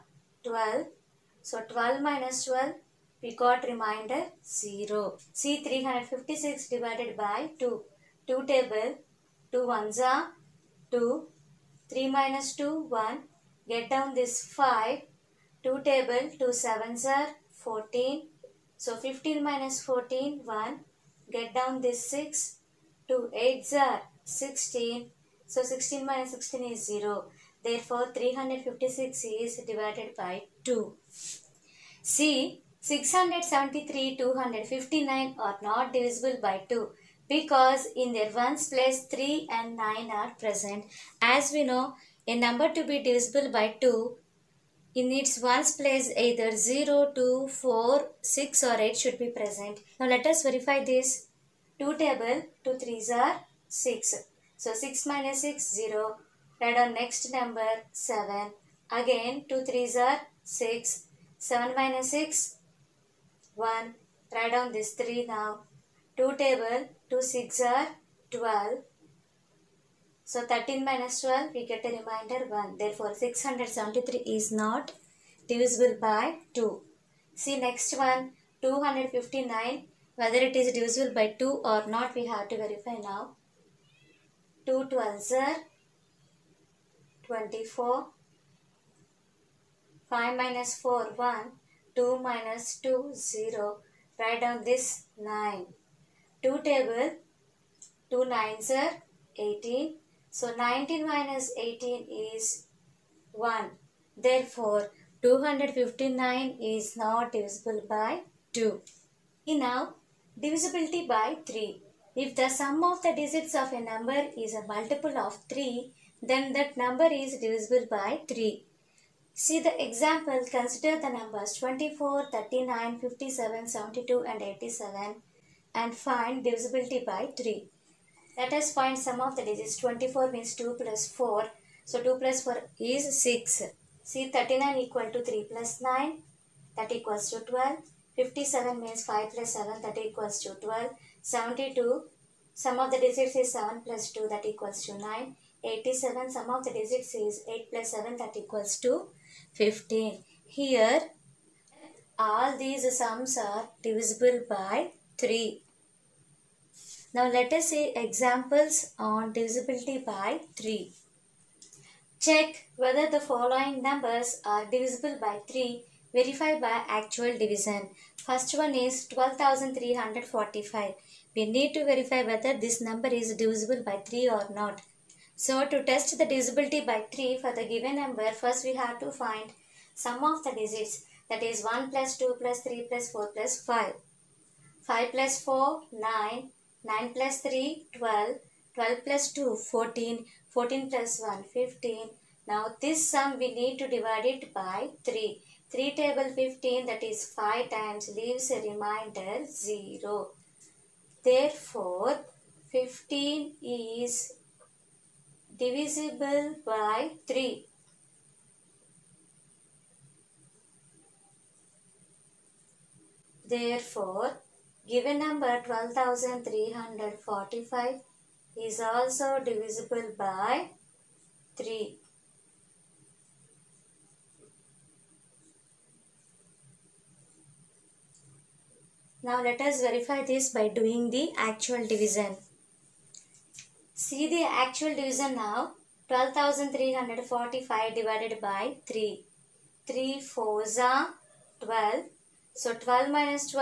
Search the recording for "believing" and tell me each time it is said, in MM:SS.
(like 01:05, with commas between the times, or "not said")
not said.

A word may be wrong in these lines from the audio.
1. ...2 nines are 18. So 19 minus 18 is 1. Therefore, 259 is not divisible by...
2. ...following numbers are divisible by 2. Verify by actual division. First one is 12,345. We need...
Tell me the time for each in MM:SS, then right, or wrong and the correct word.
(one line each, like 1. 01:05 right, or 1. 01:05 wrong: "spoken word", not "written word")
1. 01:38 right
2. 02:43 wrong: "3", not "2".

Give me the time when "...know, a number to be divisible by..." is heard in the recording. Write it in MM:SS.
00:41.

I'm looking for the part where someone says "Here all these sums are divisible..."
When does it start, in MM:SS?
02:30.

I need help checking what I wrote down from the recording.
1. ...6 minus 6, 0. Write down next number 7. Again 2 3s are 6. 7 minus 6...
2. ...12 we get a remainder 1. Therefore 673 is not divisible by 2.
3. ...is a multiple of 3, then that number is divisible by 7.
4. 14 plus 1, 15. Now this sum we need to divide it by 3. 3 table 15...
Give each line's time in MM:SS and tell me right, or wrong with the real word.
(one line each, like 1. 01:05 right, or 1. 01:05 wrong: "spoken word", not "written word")
1. 00:54 right
2. 01:11 right
3. 01:54 wrong: "3", not "7"
4. 03:10 right.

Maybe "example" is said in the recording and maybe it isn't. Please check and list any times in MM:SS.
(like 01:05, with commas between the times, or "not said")
01:59, 02:37.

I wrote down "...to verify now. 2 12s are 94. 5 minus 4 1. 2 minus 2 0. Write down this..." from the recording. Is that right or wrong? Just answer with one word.
wrong.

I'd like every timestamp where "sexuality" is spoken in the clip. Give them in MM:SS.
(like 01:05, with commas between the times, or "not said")
not said.